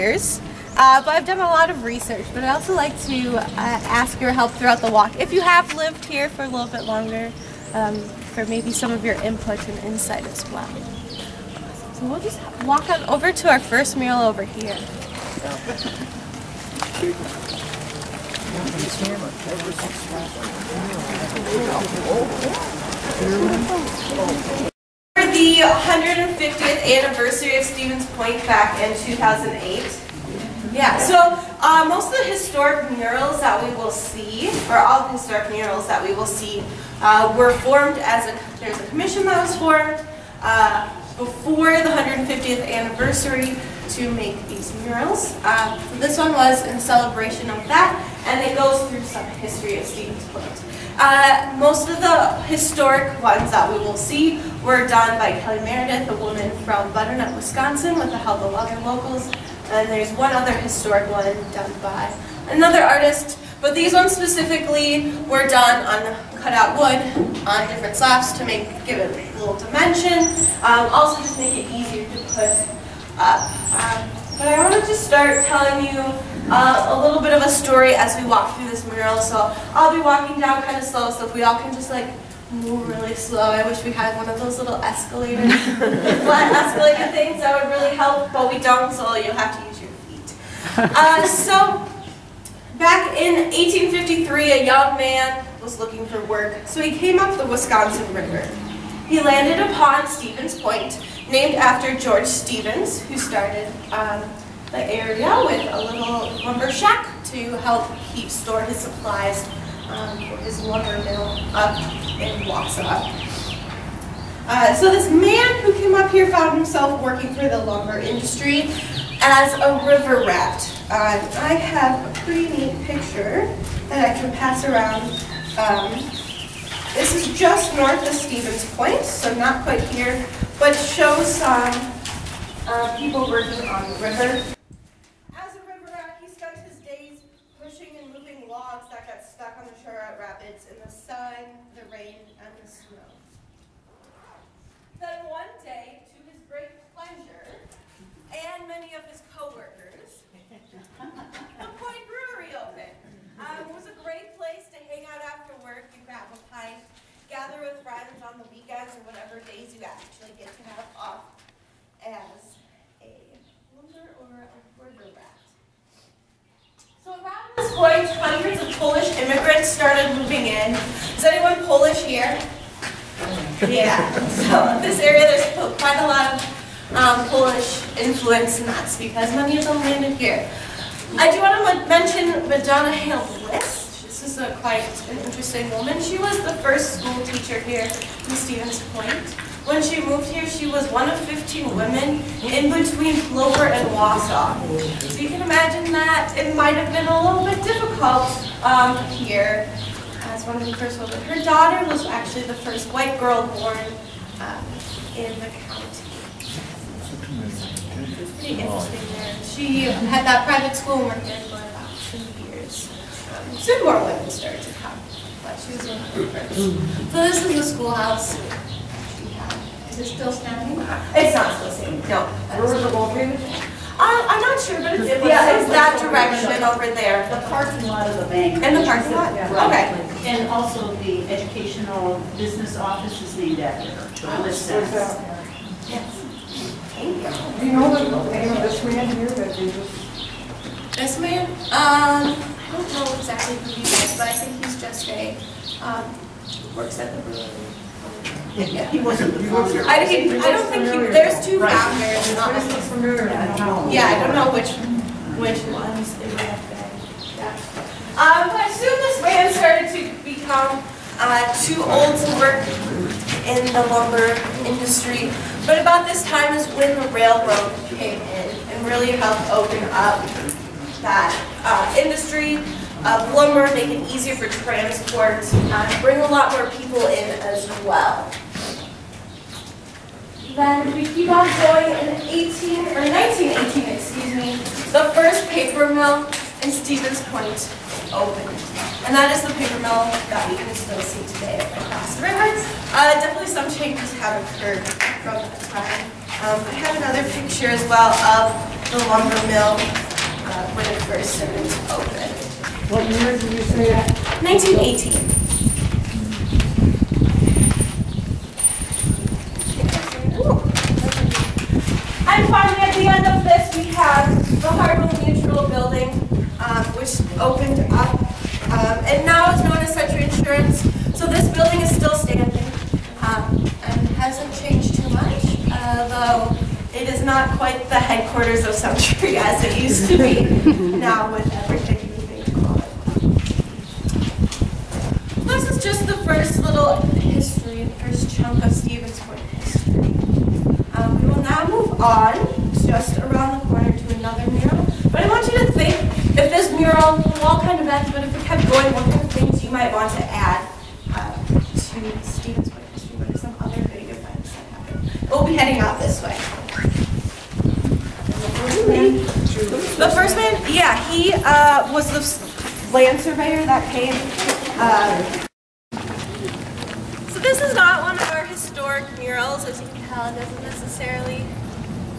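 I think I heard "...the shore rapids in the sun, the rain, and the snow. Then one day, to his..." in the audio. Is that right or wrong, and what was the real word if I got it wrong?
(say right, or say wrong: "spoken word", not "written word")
right.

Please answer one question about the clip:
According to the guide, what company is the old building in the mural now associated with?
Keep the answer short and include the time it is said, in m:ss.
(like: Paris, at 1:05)
Sentry Insurance, at 5:19.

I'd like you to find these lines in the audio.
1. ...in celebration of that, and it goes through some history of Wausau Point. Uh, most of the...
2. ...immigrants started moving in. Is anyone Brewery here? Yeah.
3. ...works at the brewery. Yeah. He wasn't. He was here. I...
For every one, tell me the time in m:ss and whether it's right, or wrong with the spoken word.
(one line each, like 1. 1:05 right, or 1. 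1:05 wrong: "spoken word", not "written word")
1. 0:46 wrong: "Stevens", not "Wausau"
2. 2:49 wrong: "Polish", not "Brewery"
3. 4:06 right.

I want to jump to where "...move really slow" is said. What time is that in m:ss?
1:22.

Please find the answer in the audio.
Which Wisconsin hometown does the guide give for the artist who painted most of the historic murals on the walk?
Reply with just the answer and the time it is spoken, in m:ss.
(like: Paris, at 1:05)
Butternut, Wisconsin, at 0:56.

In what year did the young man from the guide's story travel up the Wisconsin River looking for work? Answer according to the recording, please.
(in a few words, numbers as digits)
1853.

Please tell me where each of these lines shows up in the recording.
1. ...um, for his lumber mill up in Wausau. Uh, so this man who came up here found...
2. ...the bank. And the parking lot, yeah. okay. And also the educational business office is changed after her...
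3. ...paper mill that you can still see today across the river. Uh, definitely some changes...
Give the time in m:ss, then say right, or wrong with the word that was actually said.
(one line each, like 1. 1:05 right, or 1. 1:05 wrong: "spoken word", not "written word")
1. 1:49 right
2. 3:48 wrong: "named", not "changed"
3. 4:49 right.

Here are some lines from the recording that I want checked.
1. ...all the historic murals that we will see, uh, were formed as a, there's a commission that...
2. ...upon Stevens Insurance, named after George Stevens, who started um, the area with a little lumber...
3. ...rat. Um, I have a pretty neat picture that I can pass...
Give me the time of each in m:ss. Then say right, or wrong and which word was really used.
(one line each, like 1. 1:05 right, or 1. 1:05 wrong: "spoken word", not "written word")
1. 0:34 right
2. 1:39 wrong: "Point", not "Insurance"
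3. 2:00 right.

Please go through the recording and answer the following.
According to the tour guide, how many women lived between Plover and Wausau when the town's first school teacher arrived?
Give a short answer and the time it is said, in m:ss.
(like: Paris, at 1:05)
15, at 3:11.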